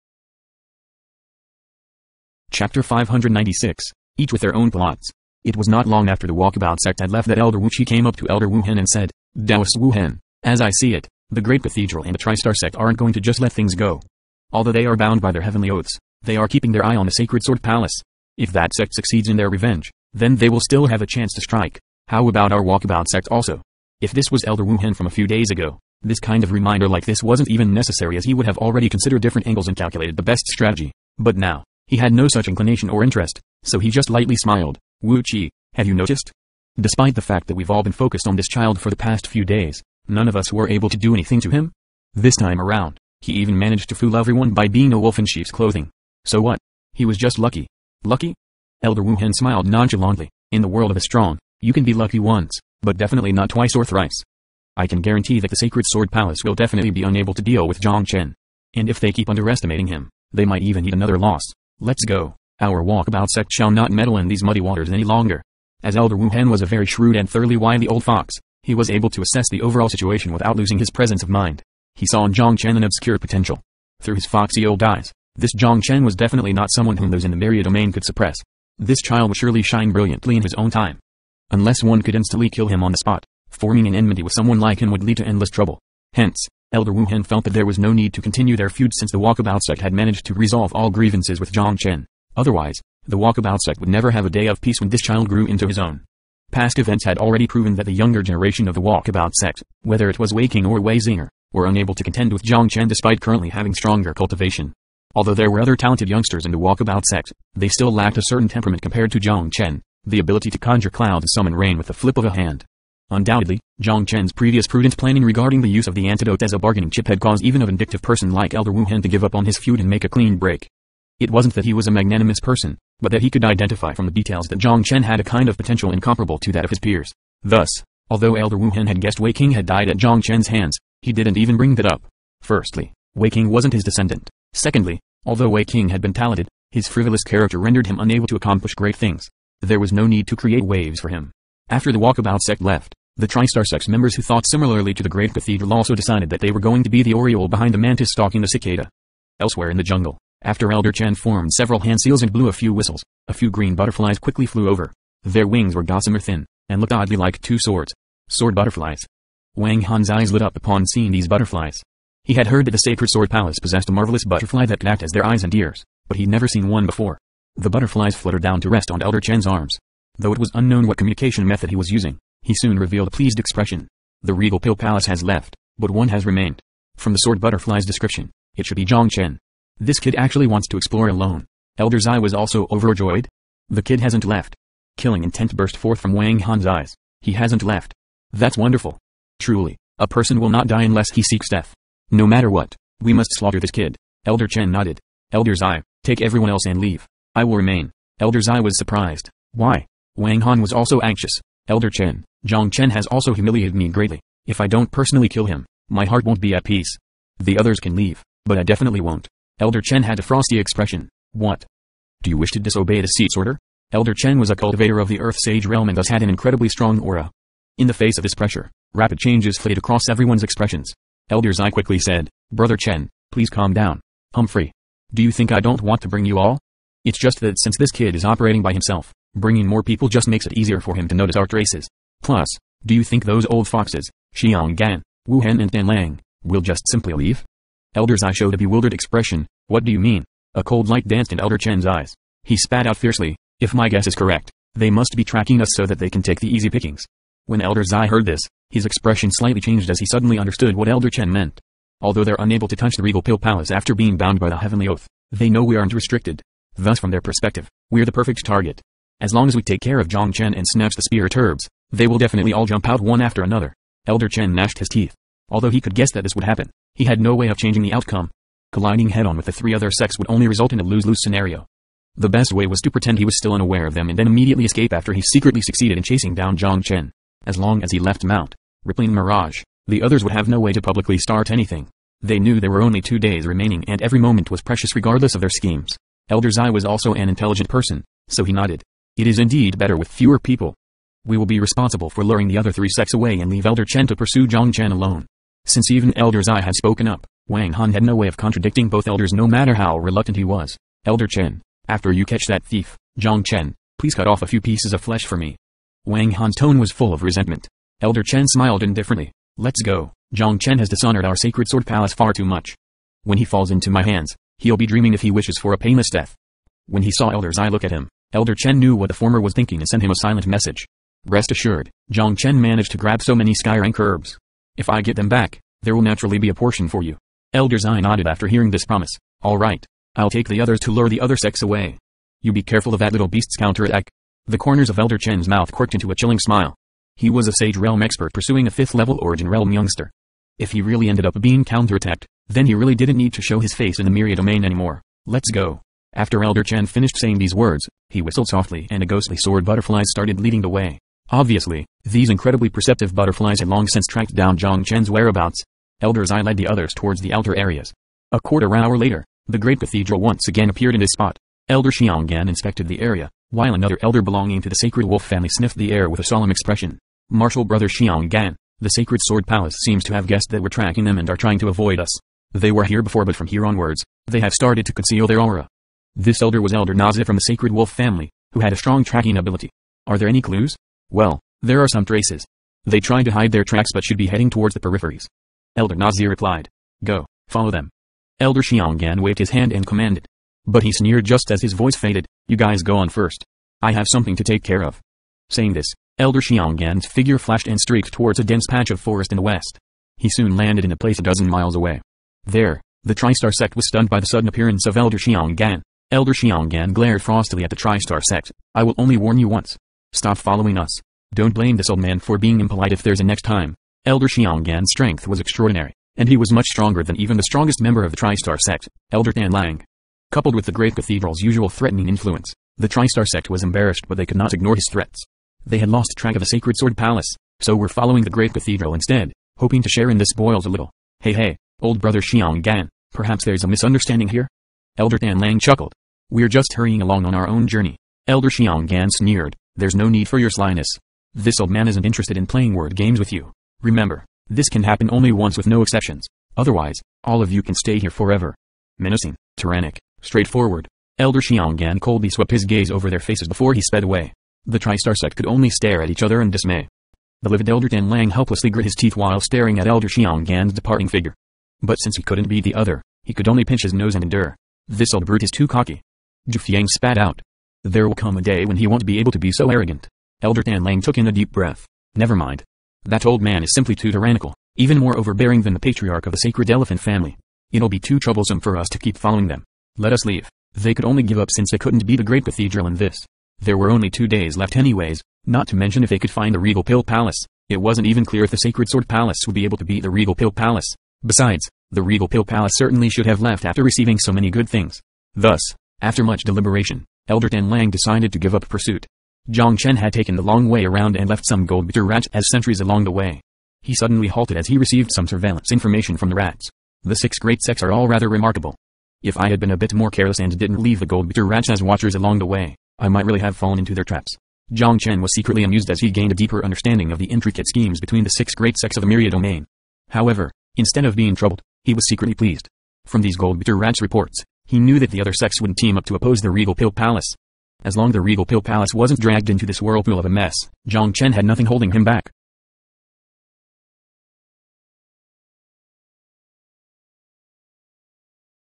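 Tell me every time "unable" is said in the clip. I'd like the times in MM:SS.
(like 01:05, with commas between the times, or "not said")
00:57, 01:41, 02:17, 04:12.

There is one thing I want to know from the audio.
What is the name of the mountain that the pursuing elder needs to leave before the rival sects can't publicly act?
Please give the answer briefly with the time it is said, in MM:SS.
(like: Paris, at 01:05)
Mount Rippling Mirage, at 04:38.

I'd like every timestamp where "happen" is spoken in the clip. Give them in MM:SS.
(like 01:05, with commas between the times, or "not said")
04:26, 07:24.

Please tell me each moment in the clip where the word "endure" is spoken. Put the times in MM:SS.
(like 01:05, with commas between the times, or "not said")
07:44.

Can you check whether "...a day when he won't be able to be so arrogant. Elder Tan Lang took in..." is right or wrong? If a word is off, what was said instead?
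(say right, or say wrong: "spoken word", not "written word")
right.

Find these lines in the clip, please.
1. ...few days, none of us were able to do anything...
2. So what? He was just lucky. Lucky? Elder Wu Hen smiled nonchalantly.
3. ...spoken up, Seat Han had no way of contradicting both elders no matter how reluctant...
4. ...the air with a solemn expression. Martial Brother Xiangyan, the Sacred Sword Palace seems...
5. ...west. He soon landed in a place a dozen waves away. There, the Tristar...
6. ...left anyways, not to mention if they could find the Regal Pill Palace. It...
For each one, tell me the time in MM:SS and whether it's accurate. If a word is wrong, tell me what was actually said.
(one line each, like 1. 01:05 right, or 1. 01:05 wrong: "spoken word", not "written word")
1. 00:39 right
2. 00:46 right
3. 04:56 wrong: "Wang", not "Seat"
4. 06:05 right
5. 06:39 wrong: "miles", not "waves"
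6. 08:04 right.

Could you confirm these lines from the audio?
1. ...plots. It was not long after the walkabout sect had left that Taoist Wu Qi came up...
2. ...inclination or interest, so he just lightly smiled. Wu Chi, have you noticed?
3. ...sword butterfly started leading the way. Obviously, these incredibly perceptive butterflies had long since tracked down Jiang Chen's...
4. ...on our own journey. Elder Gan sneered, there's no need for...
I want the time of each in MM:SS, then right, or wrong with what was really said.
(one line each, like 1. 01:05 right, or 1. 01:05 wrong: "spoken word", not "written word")
1. 00:04 wrong: "Elder", not "Taoist"
2. 00:32 right
3. 05:49 right
4. 07:17 right.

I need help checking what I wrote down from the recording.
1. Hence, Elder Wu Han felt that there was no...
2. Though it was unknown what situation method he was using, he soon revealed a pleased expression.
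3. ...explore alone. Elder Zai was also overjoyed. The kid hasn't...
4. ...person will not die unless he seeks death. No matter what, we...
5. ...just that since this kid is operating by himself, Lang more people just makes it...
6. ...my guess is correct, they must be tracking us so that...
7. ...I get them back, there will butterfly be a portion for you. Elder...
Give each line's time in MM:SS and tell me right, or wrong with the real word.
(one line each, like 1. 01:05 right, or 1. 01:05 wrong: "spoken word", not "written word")
1. 01:26 right
2. 02:50 wrong: "communication", not "situation"
3. 03:00 right
4. 03:10 right
5. 03:47 wrong: "Bringing", not "Lang"
6. 04:03 right
7. 05:24 wrong: "naturally", not "butterfly".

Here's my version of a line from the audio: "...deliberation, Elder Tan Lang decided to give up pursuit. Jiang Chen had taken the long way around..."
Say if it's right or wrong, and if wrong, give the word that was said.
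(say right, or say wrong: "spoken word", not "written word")
right.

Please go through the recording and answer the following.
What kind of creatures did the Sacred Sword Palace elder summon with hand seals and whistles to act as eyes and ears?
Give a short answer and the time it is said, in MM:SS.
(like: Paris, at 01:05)
Sword butterflies, at 02:38.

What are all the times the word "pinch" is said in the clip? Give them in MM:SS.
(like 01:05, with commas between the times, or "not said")
07:43.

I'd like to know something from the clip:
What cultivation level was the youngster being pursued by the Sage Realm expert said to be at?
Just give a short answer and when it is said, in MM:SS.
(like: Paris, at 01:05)
5th level Origin Realm, at 05:38.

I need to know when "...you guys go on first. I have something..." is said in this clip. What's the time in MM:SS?
06:32.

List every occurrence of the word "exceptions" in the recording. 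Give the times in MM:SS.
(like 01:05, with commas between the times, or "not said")
07:25.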